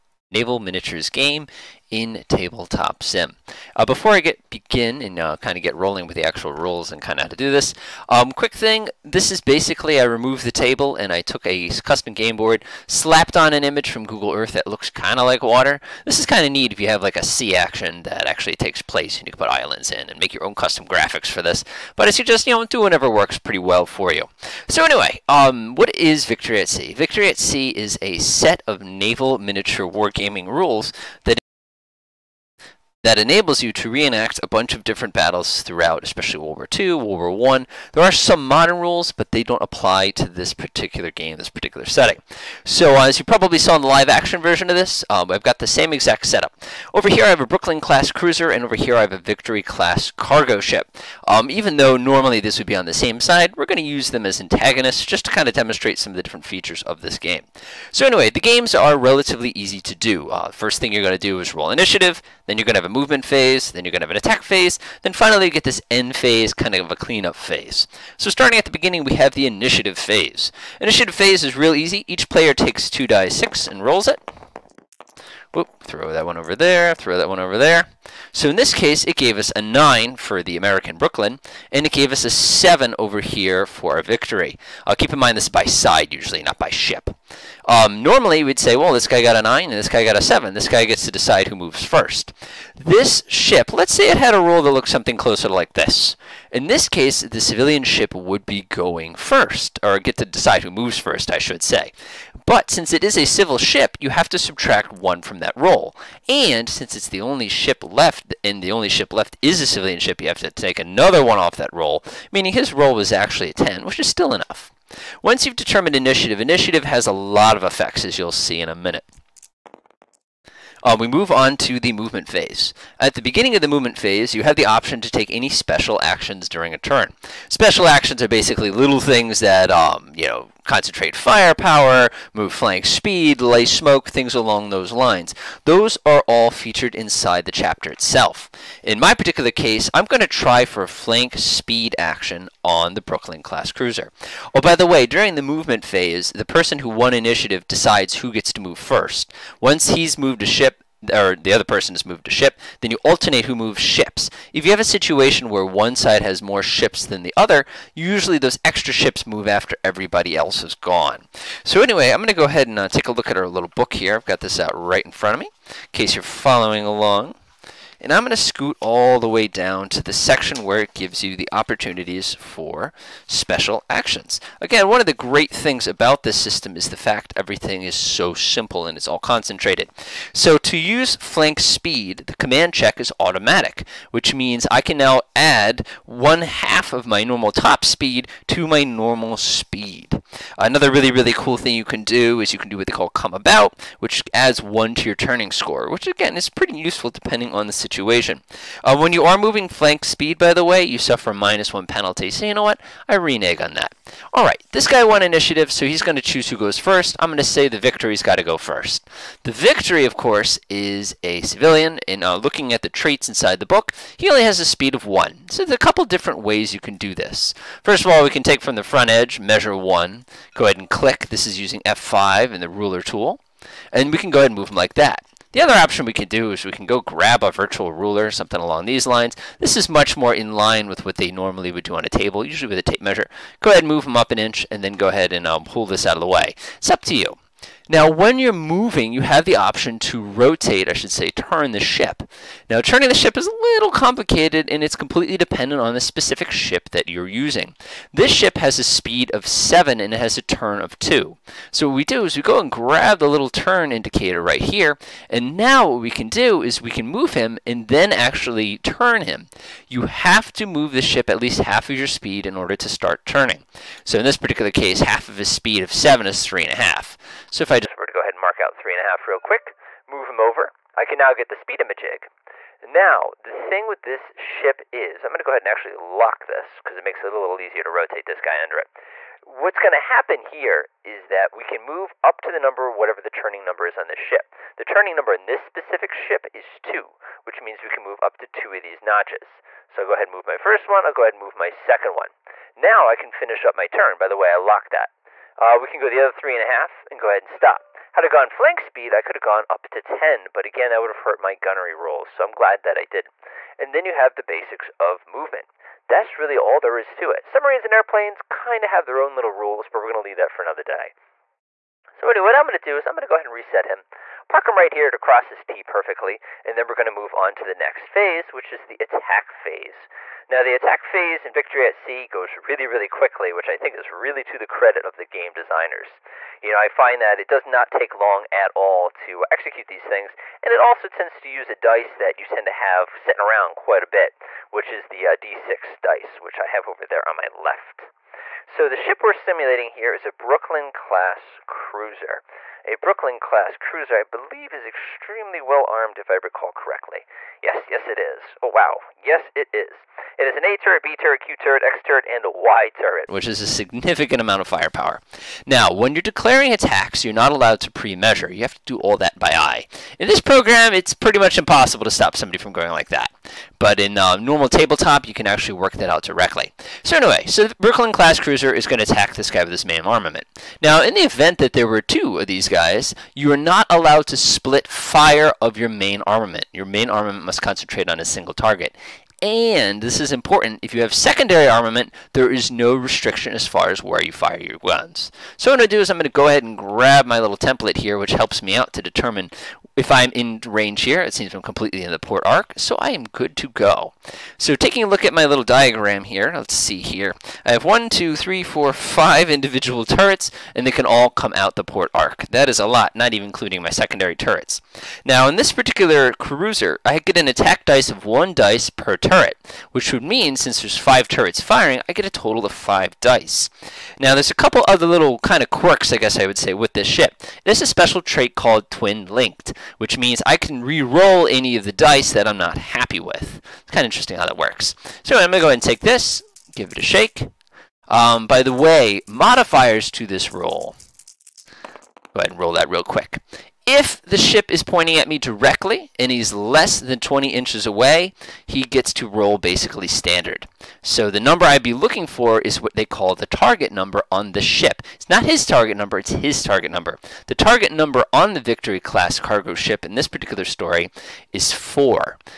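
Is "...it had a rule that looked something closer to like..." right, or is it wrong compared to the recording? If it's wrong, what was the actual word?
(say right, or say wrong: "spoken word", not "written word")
right.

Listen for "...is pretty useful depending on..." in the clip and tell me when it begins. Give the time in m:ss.
3:16.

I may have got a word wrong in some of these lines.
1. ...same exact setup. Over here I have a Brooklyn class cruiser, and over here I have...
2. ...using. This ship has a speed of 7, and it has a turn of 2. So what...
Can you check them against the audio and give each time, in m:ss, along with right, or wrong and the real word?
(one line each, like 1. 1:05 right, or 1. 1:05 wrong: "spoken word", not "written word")
1. 0:45 right
2. 4:07 right.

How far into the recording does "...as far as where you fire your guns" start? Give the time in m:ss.
6:23.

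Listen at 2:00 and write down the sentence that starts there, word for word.
Uh, we move on to the movement phase.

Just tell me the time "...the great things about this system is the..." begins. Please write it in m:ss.
2:55.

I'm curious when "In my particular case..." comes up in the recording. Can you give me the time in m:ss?
2:18.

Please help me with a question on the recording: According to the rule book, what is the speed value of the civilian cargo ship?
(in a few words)
1.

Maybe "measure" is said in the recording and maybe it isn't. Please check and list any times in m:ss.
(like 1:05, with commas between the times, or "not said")
3:39, 3:52, 5:57.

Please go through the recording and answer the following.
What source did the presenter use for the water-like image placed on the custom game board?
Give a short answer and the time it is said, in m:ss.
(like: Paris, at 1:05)
Google Earth, at 0:14.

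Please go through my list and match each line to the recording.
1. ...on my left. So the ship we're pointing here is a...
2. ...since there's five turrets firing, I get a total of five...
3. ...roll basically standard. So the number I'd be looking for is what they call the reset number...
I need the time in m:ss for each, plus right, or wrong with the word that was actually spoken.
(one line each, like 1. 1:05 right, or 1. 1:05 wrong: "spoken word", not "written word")
1. 5:37 wrong: "simulating", not "pointing"
2. 6:50 right
3. 7:19 wrong: "target", not "reset".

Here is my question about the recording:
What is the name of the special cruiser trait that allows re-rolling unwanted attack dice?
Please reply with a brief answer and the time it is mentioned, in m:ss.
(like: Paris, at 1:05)
Twin Linked, at 6:58.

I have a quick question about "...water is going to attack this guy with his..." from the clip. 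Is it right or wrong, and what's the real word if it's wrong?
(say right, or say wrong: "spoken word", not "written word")
wrong: "cruiser", not "water".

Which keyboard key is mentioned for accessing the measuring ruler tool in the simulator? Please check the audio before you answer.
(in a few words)
F5.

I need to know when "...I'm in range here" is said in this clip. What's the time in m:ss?
6:30.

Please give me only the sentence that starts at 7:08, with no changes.
Um, by the way, modifiers to this roll.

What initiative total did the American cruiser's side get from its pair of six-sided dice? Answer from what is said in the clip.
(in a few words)
9.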